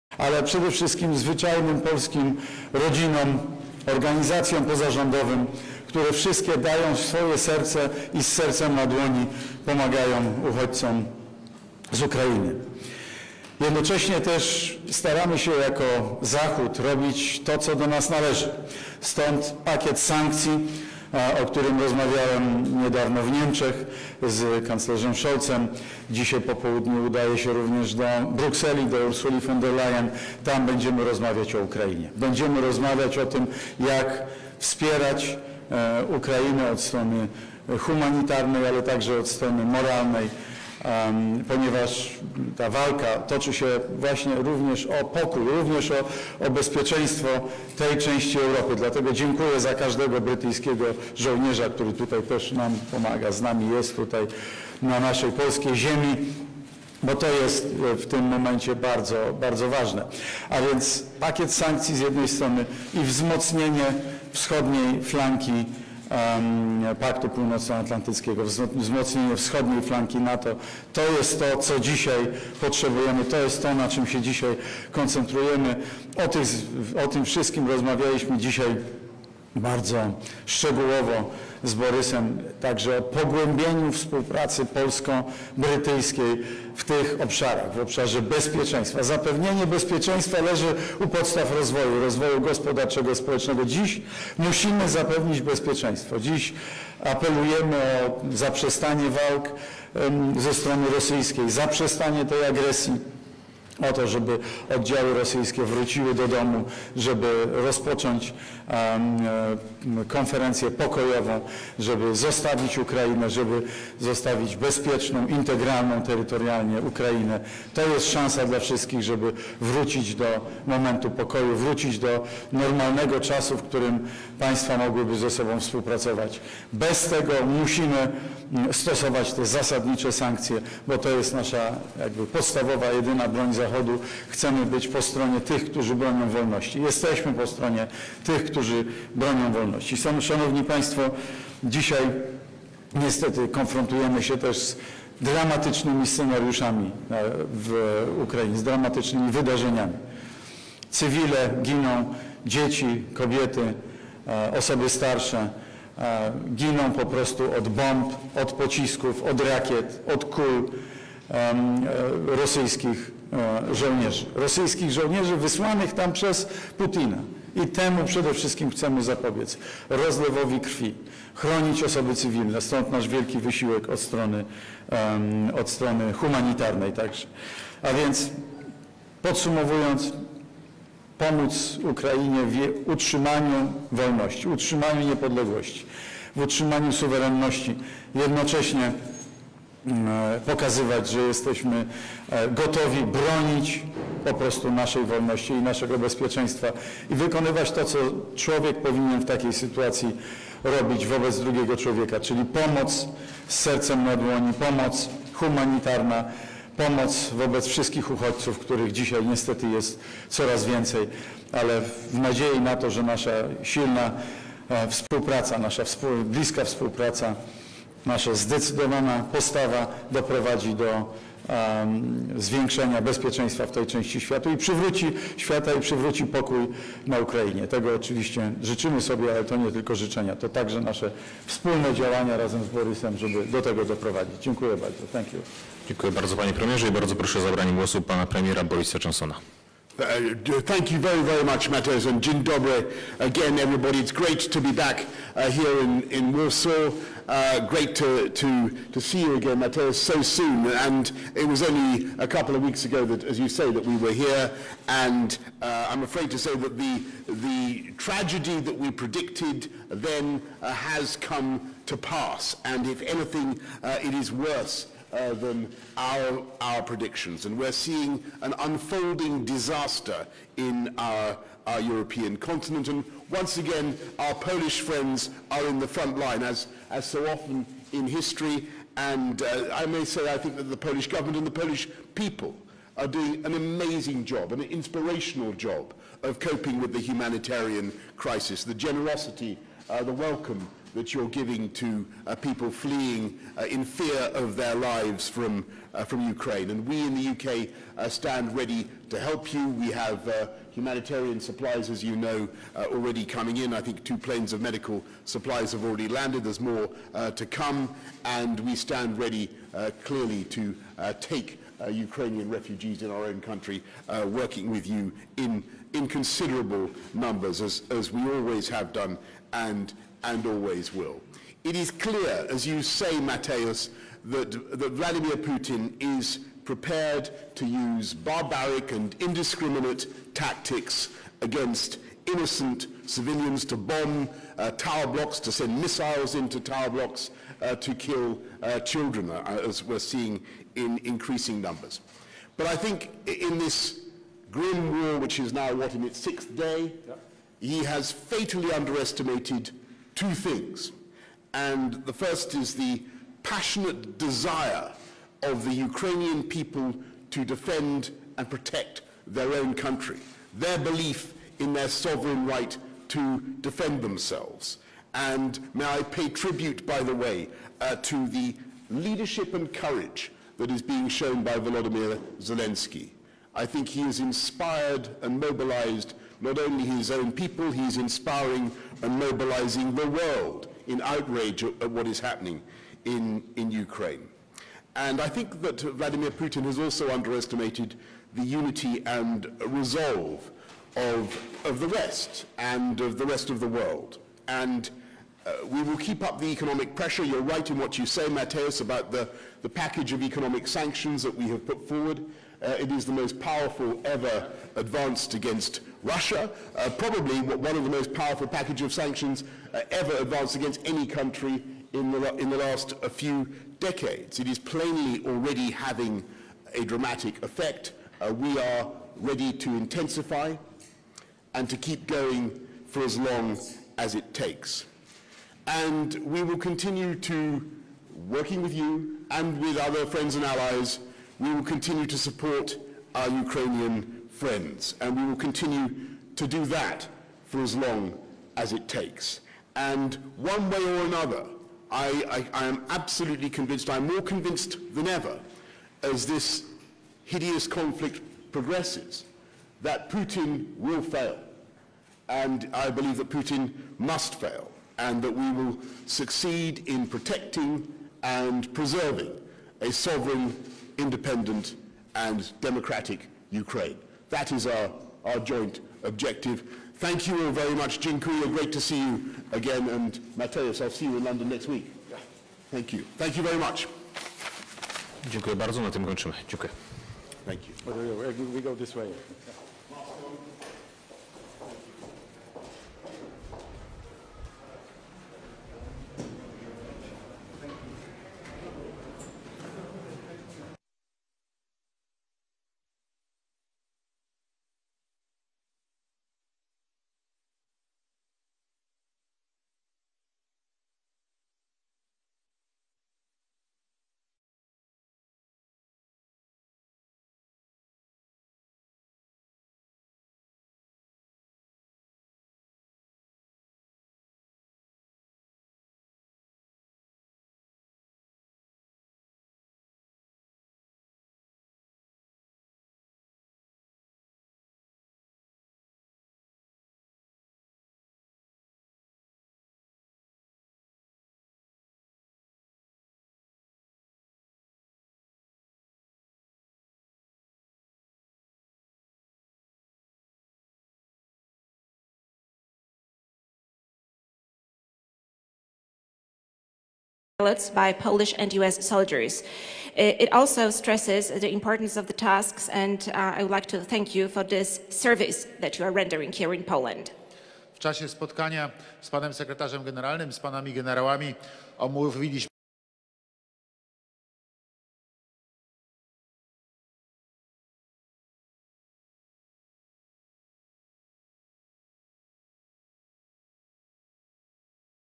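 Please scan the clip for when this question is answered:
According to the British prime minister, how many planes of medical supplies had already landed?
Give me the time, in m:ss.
5:04.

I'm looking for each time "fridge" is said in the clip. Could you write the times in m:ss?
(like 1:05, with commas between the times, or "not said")
not said.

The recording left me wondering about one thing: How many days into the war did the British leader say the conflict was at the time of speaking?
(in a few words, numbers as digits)
sixth day.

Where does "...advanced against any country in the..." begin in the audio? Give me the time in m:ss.
6:50.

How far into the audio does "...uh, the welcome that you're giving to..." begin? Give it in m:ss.
4:49.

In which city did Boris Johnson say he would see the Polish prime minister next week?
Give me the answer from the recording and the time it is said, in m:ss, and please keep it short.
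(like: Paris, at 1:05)
London, at 7:51.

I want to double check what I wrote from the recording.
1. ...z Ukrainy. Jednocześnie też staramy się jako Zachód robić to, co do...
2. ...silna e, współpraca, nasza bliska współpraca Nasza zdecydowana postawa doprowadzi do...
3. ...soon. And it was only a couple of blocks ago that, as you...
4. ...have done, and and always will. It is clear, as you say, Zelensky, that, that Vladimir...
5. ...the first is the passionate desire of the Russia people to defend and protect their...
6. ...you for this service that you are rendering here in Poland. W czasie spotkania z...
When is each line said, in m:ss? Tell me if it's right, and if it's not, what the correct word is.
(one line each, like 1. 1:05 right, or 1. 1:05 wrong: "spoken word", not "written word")
1. 0:11 right
2. 3:33 right
3. 4:10 wrong: "weeks", not "blocks"
4. 5:18 wrong: "Mateus", not "Zelensky"
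5. 5:52 wrong: "Ukrainian", not "Russia"
6. 9:14 right.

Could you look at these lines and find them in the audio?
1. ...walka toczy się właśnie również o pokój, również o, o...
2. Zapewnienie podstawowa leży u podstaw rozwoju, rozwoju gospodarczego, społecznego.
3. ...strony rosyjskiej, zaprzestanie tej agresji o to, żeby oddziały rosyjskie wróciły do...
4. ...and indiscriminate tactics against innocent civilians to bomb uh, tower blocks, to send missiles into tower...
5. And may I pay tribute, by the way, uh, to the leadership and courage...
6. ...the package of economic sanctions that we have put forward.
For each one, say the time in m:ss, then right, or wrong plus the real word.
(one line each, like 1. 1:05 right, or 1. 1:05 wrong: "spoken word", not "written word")
1. 0:42 right
2. 1:29 wrong: "bezpieczeństwa", not "podstawowa"
3. 1:40 right
4. 5:28 right
5. 6:05 right
6. 6:39 right.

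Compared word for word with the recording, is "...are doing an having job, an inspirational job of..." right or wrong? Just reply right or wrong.
wrong.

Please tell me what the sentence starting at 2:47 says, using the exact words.
I temu przede wszystkim chcemy zapobiec.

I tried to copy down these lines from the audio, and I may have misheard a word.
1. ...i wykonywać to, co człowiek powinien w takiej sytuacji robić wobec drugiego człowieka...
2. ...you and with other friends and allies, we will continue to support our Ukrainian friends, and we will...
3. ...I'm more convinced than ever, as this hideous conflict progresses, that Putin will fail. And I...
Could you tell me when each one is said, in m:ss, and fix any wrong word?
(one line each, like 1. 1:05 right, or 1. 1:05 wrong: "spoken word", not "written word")
1. 3:17 right
2. 7:08 right
3. 7:23 right.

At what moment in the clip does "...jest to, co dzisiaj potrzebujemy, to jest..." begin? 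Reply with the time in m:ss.
1:11.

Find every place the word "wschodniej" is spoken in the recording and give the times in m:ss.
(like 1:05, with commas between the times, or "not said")
1:04, 1:09.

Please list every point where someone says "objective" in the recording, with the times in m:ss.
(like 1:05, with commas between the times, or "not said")
7:46.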